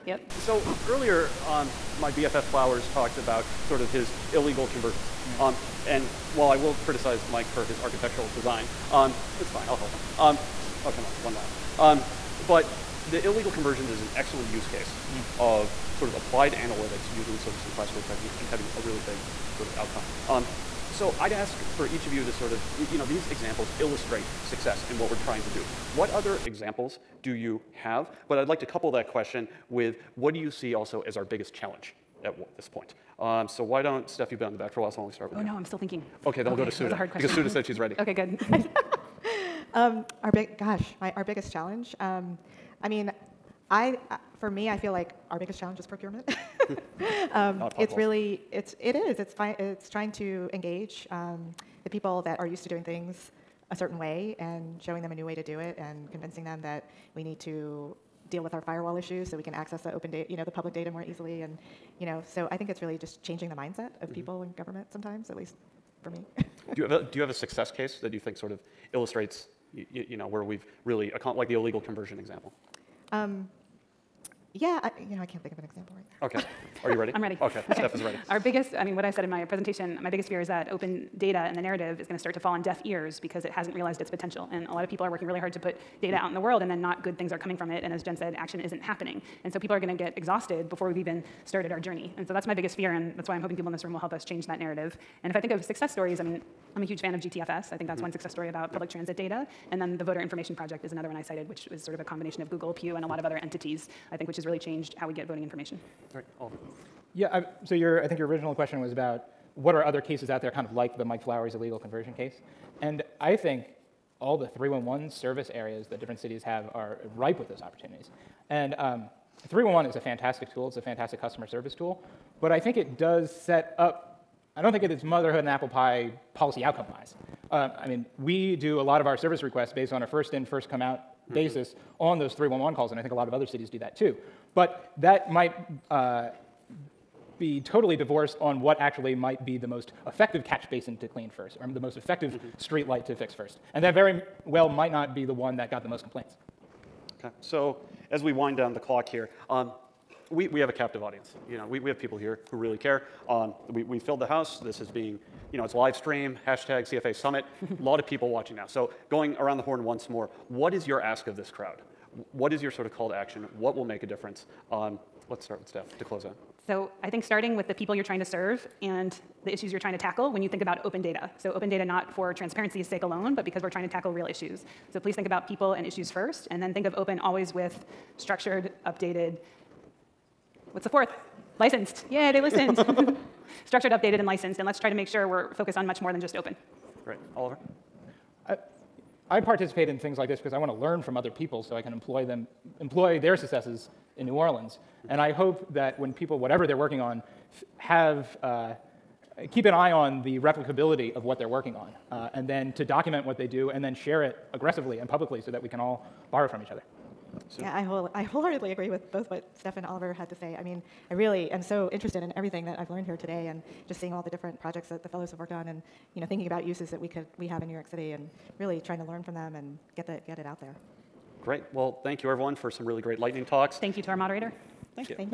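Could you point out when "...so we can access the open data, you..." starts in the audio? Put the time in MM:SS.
00:59.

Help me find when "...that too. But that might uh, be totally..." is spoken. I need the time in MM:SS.
02:13.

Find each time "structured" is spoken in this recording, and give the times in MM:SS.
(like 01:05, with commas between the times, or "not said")
02:58, 03:03.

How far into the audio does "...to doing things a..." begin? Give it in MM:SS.
00:52.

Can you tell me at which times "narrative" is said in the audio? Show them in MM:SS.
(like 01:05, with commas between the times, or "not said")
01:21, 01:34.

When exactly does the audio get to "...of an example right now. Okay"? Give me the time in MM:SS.
01:15.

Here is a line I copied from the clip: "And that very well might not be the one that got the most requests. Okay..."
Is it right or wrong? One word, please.
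wrong.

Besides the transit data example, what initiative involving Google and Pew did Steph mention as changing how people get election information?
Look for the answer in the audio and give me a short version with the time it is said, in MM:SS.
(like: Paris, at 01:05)
Voter Information Project, at 01:40.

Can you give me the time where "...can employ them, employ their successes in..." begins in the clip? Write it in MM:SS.
03:11.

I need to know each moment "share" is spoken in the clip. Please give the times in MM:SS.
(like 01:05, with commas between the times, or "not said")
03:23.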